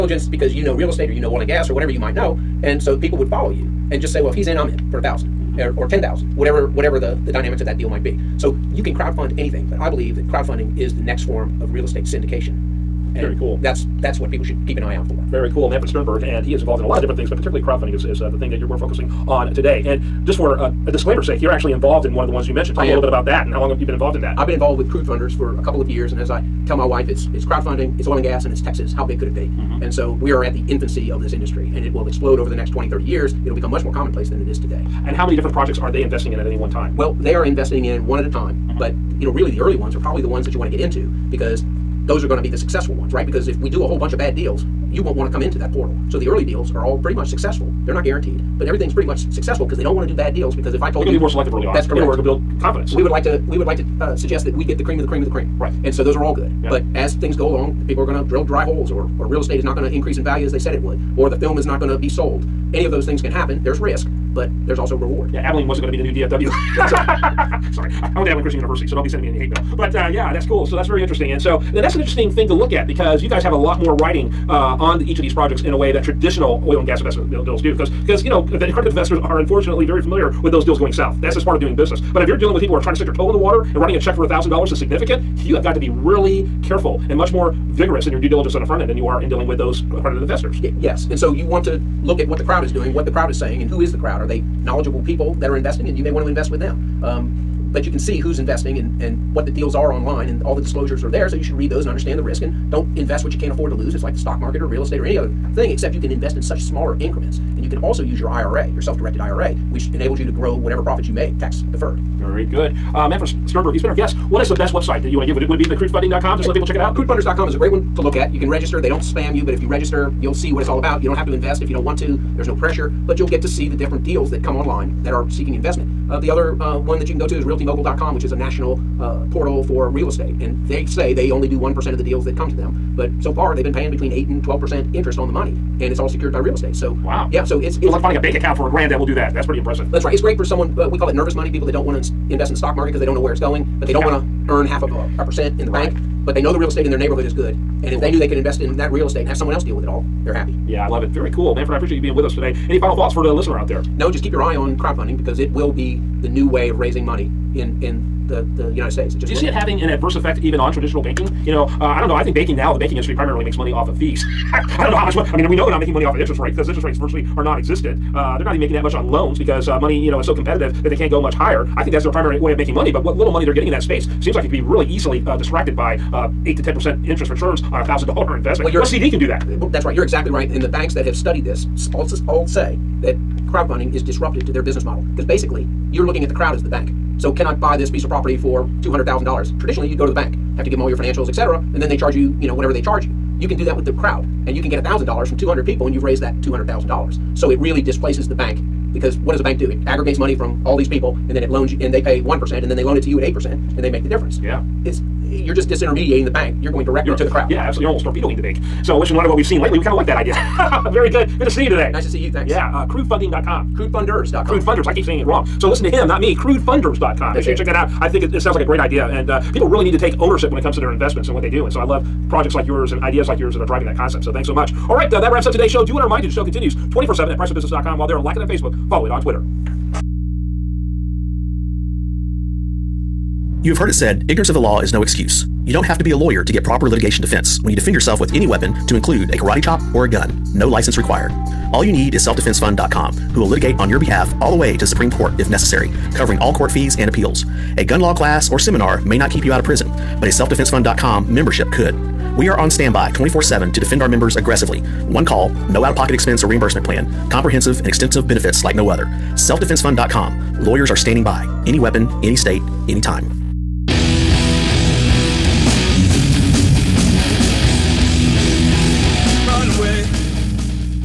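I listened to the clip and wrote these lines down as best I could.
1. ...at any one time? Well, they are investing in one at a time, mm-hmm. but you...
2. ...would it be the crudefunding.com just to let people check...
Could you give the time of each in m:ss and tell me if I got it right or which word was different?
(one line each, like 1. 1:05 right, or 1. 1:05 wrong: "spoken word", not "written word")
1. 0:36 right
2. 1:55 right.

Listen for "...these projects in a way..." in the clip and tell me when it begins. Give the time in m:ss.
1:15.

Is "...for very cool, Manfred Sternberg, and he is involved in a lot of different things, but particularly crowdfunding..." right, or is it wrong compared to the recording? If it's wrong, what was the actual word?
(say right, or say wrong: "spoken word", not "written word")
right.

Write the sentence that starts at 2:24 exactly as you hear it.
want to earn half of a, a percent in the right.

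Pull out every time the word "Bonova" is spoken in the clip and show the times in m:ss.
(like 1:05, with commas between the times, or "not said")
not said.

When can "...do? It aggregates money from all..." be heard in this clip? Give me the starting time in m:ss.
3:19.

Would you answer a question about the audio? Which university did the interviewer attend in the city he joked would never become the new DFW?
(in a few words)
Abilene Christian University.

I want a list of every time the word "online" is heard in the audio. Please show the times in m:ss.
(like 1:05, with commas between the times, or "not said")
1:39, 2:04.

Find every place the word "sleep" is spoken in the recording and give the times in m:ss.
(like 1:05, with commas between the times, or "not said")
not said.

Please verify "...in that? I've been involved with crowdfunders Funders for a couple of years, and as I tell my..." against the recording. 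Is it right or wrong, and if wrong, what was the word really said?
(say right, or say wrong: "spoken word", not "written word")
right.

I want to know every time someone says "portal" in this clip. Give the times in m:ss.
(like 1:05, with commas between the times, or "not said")
0:45, 2:09.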